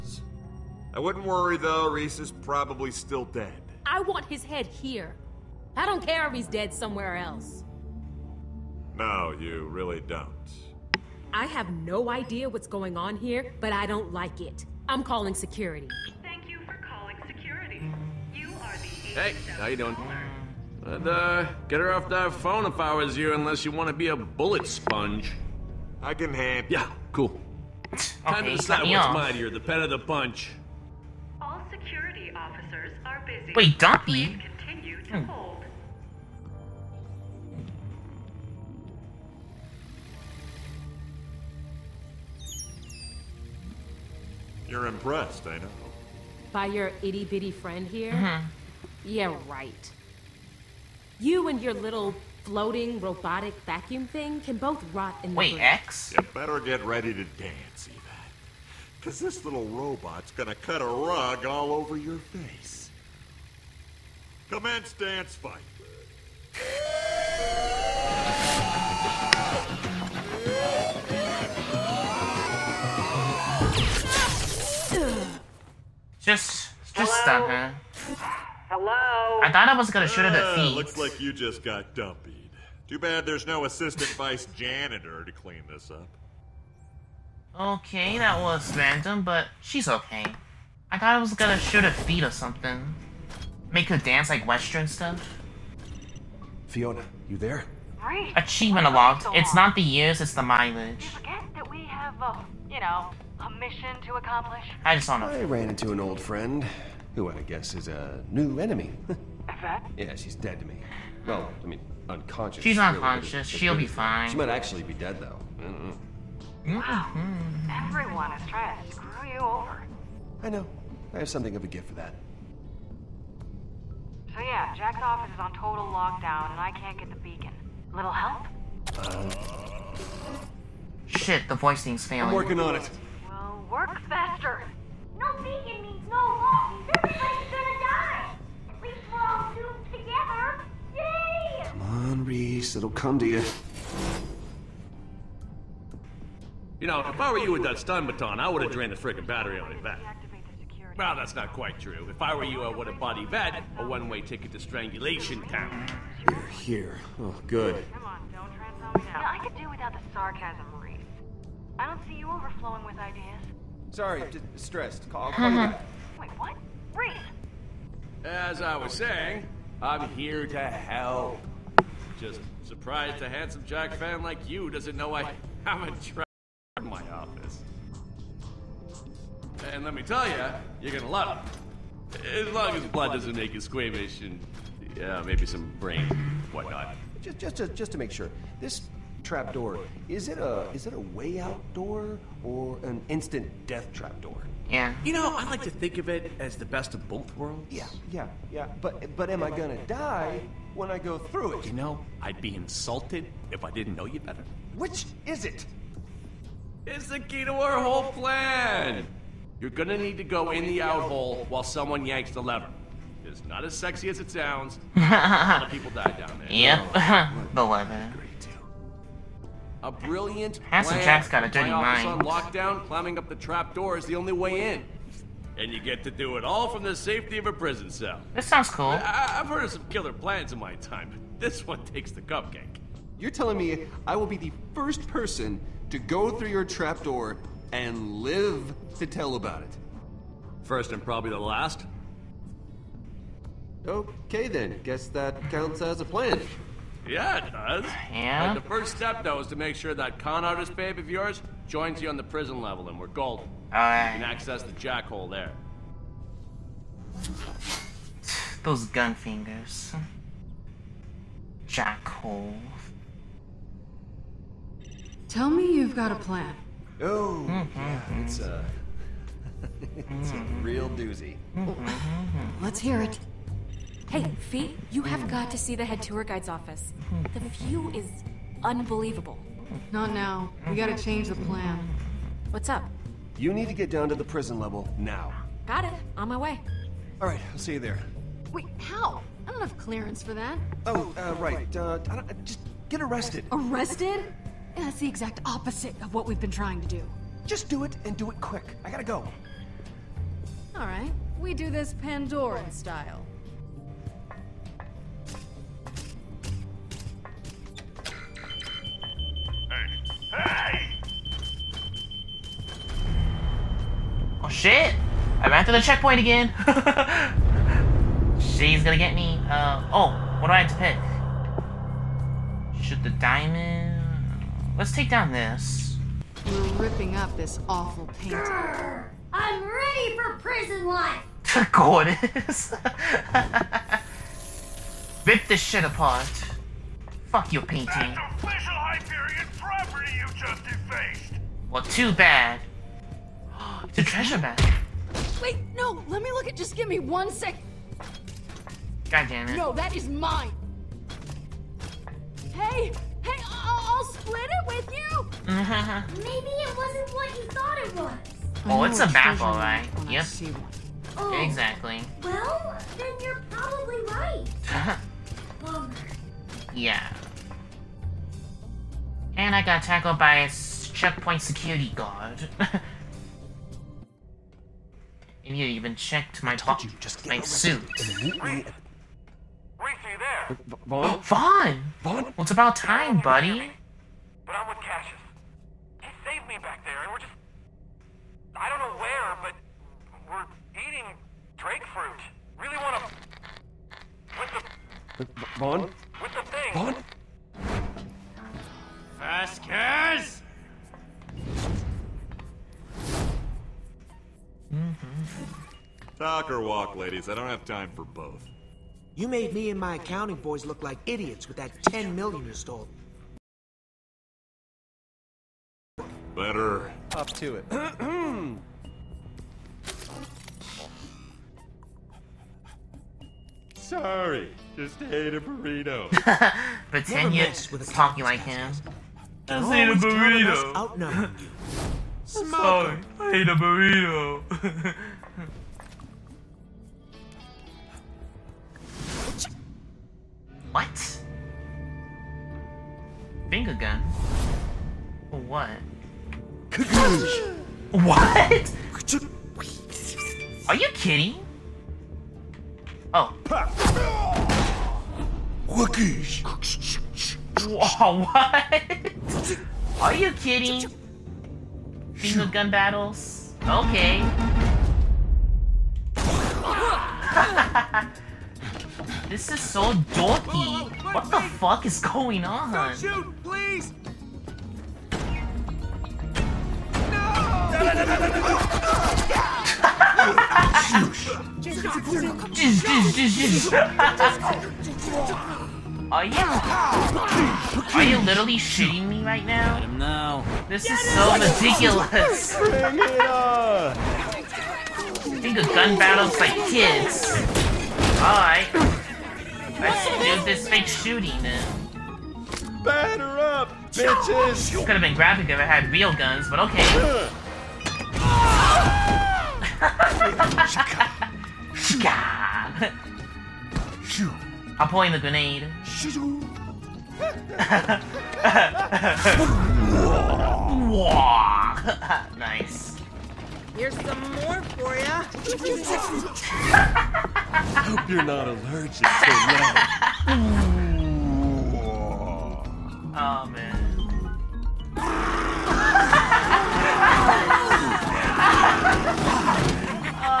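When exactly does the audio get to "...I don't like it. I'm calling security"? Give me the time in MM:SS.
00:13.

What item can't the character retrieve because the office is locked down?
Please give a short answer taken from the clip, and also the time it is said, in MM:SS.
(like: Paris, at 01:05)
the beacon, at 02:07.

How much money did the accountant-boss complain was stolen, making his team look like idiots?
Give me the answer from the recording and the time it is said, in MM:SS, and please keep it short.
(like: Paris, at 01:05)
10 million, at 06:51.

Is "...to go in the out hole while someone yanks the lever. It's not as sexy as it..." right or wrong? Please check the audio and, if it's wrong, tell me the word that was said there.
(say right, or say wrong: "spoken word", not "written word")
right.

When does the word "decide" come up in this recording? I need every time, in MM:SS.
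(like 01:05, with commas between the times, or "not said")
00:28.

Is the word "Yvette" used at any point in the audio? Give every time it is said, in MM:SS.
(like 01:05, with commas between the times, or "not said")
00:57, 02:33.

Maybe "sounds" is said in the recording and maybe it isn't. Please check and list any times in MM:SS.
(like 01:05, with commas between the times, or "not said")
03:34, 03:48.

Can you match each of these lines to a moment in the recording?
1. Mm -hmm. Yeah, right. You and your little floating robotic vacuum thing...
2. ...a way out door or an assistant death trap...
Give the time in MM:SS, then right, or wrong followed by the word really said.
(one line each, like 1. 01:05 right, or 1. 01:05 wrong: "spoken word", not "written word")
1. 00:48 right
2. 03:10 wrong: "instant", not "assistant".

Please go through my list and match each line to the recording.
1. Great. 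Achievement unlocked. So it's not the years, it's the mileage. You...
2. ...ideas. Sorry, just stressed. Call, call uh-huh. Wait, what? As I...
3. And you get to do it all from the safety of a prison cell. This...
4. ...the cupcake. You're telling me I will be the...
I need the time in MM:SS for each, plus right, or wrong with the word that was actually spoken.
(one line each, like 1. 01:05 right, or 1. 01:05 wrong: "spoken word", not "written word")
1. 01:37 right
2. 02:42 right
3. 03:45 right
4. 03:52 right.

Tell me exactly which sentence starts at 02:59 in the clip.
And let me tell you, you're gonna love it.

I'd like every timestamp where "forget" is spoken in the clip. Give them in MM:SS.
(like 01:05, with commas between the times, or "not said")
01:41.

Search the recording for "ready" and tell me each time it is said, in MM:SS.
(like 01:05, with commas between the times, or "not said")
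00:56, 05:29.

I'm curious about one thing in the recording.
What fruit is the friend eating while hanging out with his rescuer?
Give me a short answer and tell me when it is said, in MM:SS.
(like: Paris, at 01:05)
drake fruit, at 06:31.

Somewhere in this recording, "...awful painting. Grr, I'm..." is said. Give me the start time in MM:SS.
05:27.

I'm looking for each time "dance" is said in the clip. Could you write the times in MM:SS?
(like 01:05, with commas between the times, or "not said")
00:57, 01:04, 01:33.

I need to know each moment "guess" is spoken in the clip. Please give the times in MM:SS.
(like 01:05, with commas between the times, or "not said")
01:47, 04:04.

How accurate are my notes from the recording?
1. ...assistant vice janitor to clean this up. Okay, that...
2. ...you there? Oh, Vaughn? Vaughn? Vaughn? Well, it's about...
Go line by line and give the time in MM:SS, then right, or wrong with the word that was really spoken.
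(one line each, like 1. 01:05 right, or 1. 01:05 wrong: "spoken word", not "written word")
1. 01:23 right
2. 06:18 right.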